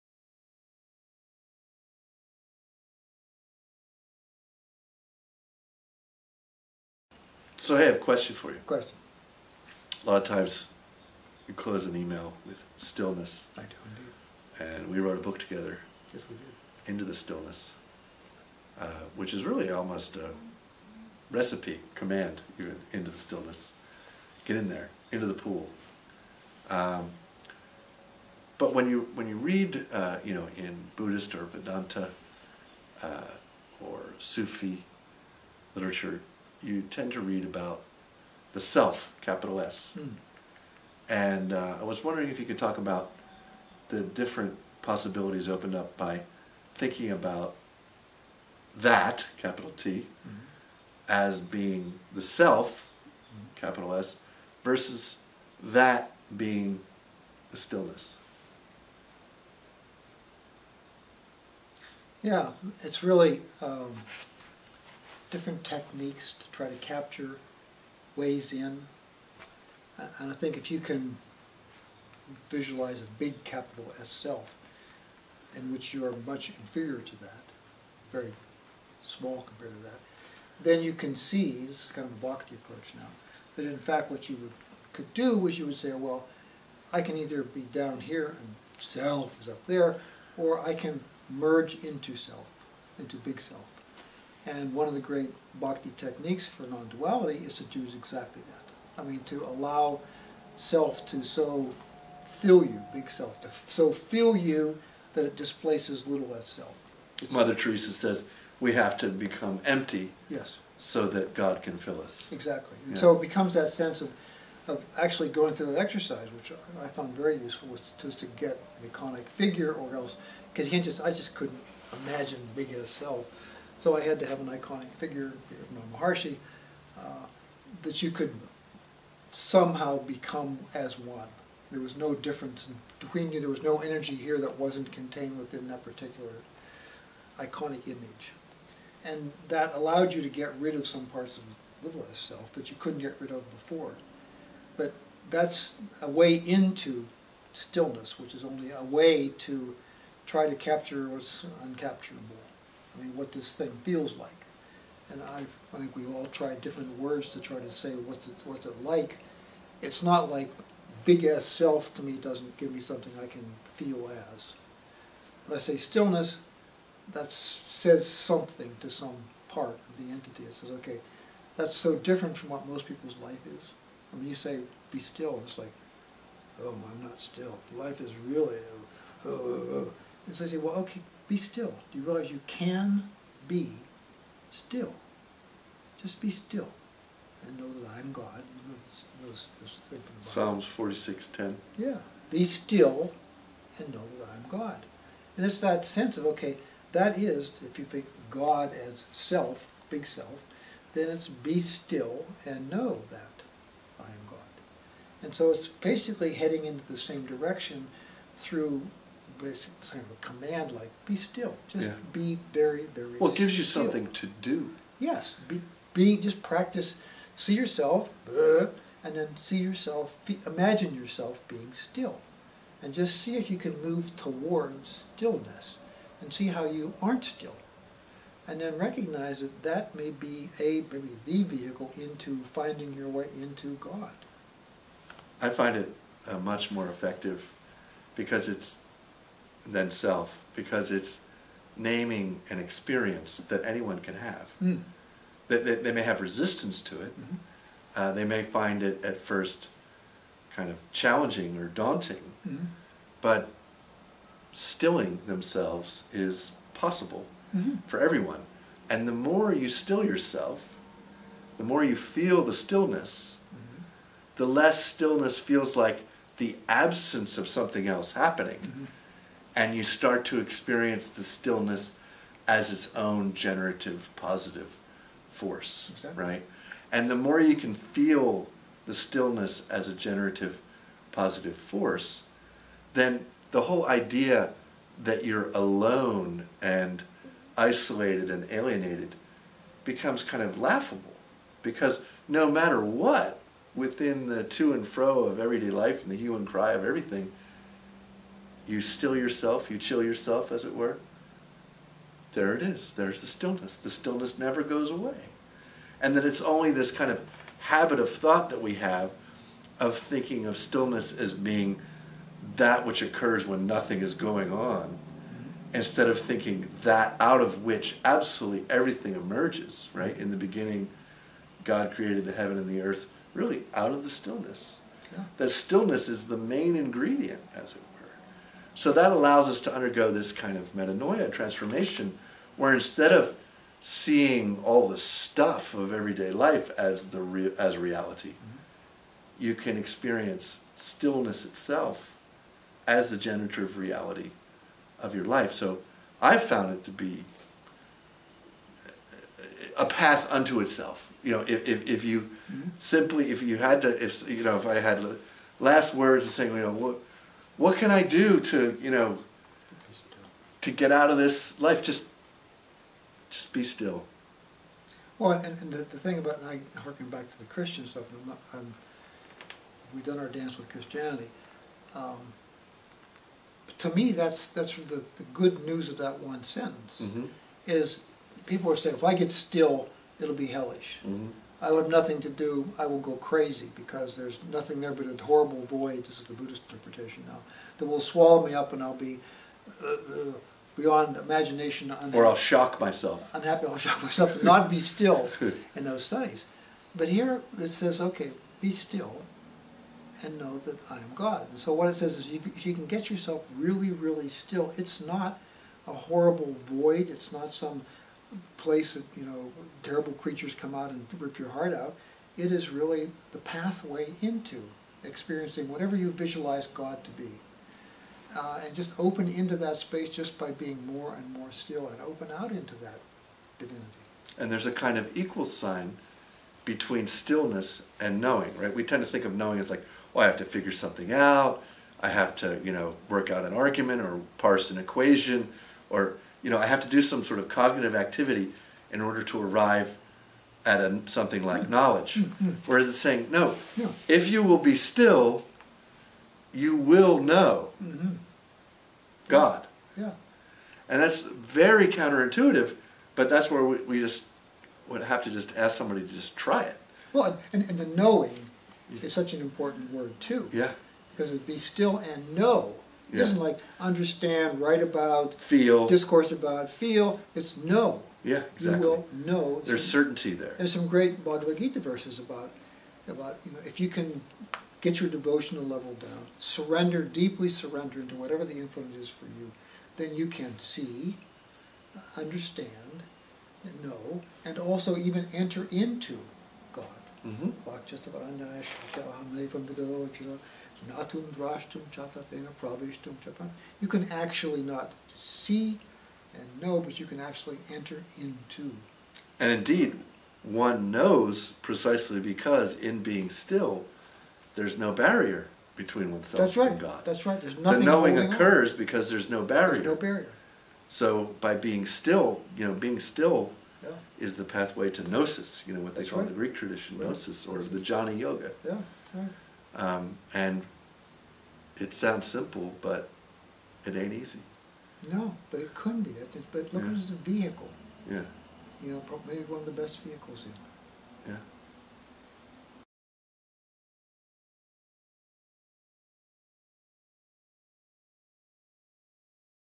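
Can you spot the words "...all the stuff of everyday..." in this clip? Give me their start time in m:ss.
5:34.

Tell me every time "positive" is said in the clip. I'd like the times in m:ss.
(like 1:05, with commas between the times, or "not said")
4:34, 4:41.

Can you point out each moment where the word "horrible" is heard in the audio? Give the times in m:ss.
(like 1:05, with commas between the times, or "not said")
6:25, 6:45.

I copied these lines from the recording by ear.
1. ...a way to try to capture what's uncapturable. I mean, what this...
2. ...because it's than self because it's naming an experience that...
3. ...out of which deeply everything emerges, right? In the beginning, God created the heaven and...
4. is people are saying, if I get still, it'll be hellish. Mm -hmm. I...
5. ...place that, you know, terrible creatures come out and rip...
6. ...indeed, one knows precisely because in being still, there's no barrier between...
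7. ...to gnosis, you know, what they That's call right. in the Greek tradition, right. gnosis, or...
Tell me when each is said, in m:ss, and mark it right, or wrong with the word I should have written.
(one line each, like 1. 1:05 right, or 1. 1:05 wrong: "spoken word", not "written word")
1. 2:28 right
2. 3:58 right
3. 5:17 wrong: "absolutely", not "deeply"
4. 6:17 right
5. 6:48 right
6. 8:19 right
7. 8:34 right.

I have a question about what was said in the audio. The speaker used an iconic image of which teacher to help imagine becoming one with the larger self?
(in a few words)
Maharshi.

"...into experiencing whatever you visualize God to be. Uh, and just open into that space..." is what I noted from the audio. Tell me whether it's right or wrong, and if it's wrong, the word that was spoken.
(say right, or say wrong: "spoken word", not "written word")
right.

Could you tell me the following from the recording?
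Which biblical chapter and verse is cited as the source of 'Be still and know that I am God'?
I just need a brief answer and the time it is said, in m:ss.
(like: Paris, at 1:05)
Psalms 46:10, at 3:10.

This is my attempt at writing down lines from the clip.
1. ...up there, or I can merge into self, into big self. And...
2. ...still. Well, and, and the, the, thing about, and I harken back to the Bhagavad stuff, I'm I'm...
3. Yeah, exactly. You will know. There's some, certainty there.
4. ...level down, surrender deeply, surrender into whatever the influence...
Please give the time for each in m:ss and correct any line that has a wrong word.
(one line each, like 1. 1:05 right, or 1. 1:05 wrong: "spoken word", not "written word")
1. 1:29 right
2. 6:03 wrong: "Christian", not "Bhagavad"
3. 7:48 right
4. 7:55 right.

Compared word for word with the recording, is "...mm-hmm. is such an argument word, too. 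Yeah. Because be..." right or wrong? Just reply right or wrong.
wrong.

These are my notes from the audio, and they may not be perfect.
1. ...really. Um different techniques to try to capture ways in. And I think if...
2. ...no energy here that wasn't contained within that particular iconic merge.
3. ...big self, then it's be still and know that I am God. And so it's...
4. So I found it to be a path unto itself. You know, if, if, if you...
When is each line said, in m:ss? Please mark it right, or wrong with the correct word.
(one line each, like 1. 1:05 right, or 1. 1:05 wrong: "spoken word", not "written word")
1. 1:03 right
2. 2:13 wrong: "image", not "merge"
3. 3:19 right
4. 5:45 right.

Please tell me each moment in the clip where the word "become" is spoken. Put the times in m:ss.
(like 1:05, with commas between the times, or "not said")
1:49, 1:53, 2:09, 4:49.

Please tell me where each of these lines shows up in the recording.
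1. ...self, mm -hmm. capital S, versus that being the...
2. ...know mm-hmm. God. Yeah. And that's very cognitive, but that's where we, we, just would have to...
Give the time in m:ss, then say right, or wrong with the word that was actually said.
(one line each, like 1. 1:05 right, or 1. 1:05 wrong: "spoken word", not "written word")
1. 0:52 right
2. 7:27 wrong: "counterintuitive", not "cognitive".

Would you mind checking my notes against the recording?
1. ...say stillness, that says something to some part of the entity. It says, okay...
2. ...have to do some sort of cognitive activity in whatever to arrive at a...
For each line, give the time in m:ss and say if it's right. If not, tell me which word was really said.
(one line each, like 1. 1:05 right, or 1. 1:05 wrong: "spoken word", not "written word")
1. 2:45 right
2. 7:16 wrong: "order", not "whatever".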